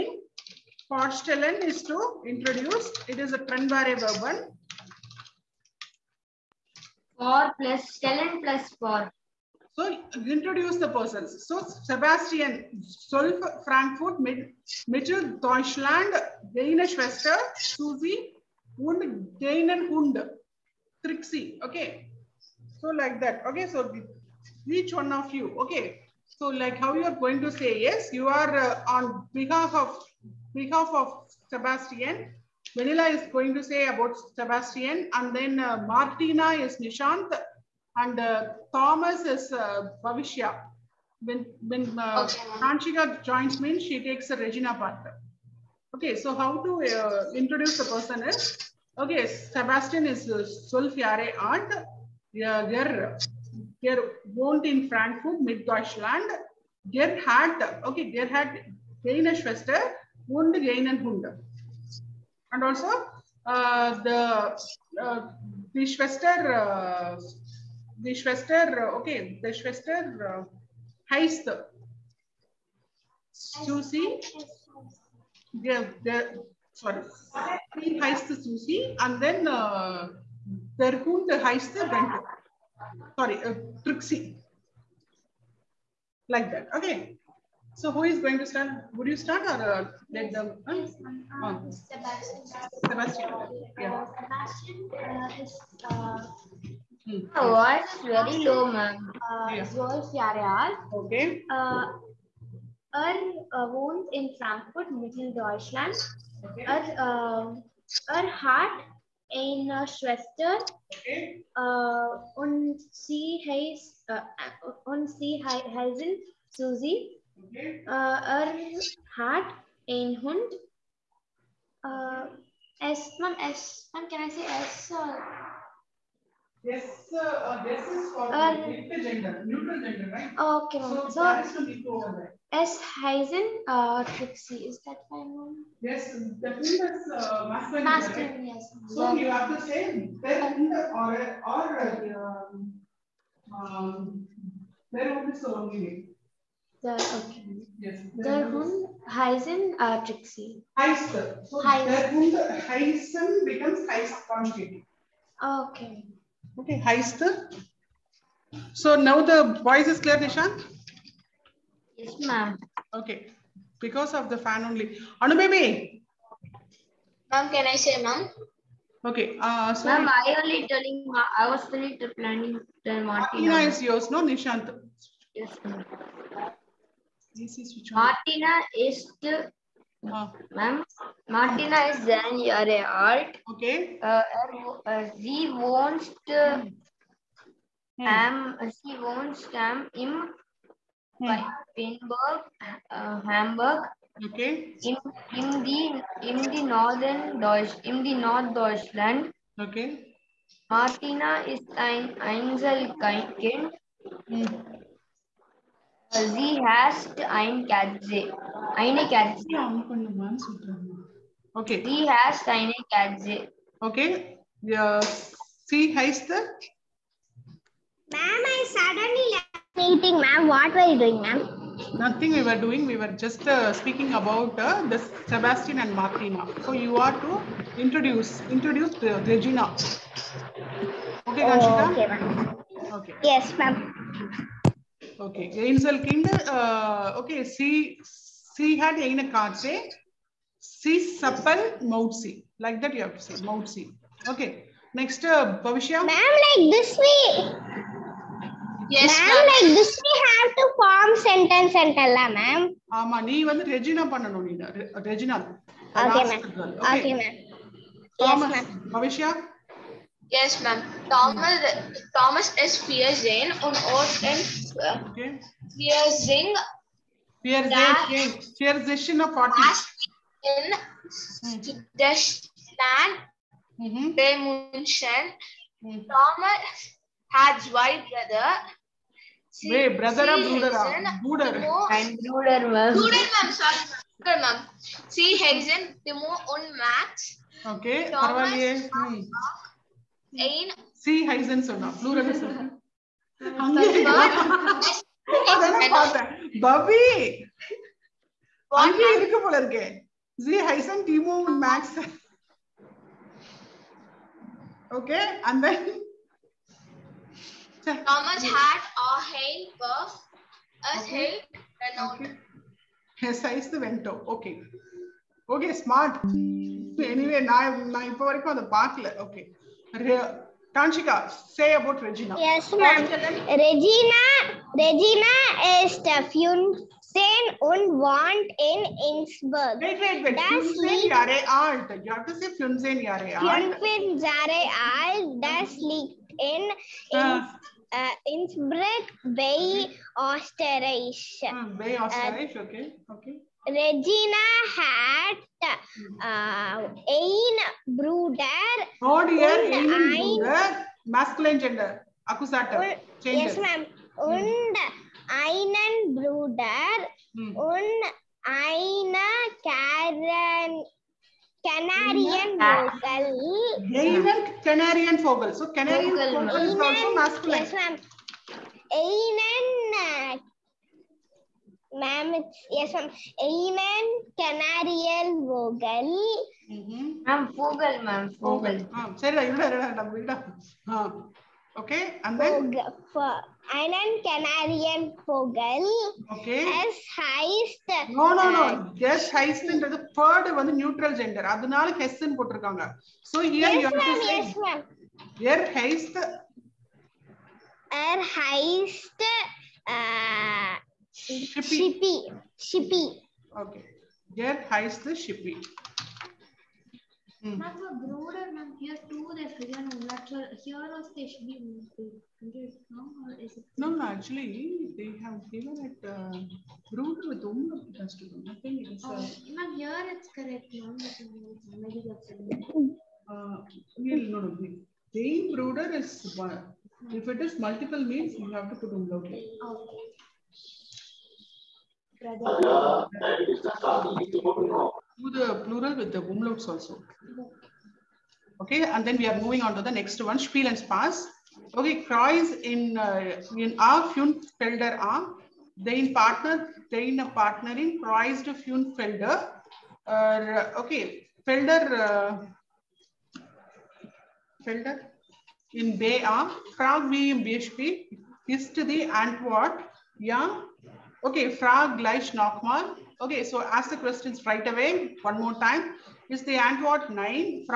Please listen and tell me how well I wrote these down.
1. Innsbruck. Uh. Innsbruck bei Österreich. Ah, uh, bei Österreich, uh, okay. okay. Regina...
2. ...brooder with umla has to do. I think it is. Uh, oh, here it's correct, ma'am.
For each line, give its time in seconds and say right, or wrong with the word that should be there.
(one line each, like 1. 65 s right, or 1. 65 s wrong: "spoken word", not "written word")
1. 337 s right
2. 416 s right.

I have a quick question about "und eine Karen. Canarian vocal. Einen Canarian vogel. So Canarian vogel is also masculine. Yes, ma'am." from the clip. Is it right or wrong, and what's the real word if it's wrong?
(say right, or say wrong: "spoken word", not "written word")
right.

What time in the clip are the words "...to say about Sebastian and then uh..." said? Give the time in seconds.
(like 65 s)
33 s.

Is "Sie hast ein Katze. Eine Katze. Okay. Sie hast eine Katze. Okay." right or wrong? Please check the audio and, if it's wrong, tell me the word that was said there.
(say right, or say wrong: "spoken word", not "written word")
right.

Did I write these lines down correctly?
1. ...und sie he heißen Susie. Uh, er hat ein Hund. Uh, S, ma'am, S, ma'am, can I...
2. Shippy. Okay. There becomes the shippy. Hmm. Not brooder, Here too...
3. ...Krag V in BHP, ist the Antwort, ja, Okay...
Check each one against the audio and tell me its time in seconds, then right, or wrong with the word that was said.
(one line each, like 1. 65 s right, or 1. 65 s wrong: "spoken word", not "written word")
1. 114 s right
2. 402 s wrong: "hides", not "becomes"
3. 456 s right.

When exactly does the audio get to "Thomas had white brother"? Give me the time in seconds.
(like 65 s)
276 s.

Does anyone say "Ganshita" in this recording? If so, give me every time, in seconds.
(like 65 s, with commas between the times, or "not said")
231 s.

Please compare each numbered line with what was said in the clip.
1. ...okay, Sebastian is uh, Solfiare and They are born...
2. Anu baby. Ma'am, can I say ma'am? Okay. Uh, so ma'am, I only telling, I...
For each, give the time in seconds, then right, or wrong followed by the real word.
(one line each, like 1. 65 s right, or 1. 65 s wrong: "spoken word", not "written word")
1. 48 s right
2. 165 s right.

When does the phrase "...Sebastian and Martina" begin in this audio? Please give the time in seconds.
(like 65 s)
225 s.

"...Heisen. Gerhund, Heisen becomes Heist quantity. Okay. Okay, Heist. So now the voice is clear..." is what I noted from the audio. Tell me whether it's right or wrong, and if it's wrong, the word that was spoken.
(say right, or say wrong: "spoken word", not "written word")
right.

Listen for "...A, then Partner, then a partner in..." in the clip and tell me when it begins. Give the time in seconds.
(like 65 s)
444 s.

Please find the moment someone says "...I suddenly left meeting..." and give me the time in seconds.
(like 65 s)
218 s.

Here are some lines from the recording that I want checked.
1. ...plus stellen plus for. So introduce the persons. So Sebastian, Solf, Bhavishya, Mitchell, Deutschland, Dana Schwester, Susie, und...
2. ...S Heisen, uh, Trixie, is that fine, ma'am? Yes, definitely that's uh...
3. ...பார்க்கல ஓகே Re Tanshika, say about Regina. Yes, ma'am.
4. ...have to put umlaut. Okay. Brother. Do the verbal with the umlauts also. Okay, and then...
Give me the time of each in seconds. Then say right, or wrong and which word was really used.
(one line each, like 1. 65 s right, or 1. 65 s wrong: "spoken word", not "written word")
1. 7 s wrong: "Frankfurt", not "Bhavishya"
2. 132 s right
3. 318 s right
4. 428 s wrong: "plural", not "verbal".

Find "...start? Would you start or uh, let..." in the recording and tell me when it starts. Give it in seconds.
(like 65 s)
88 s.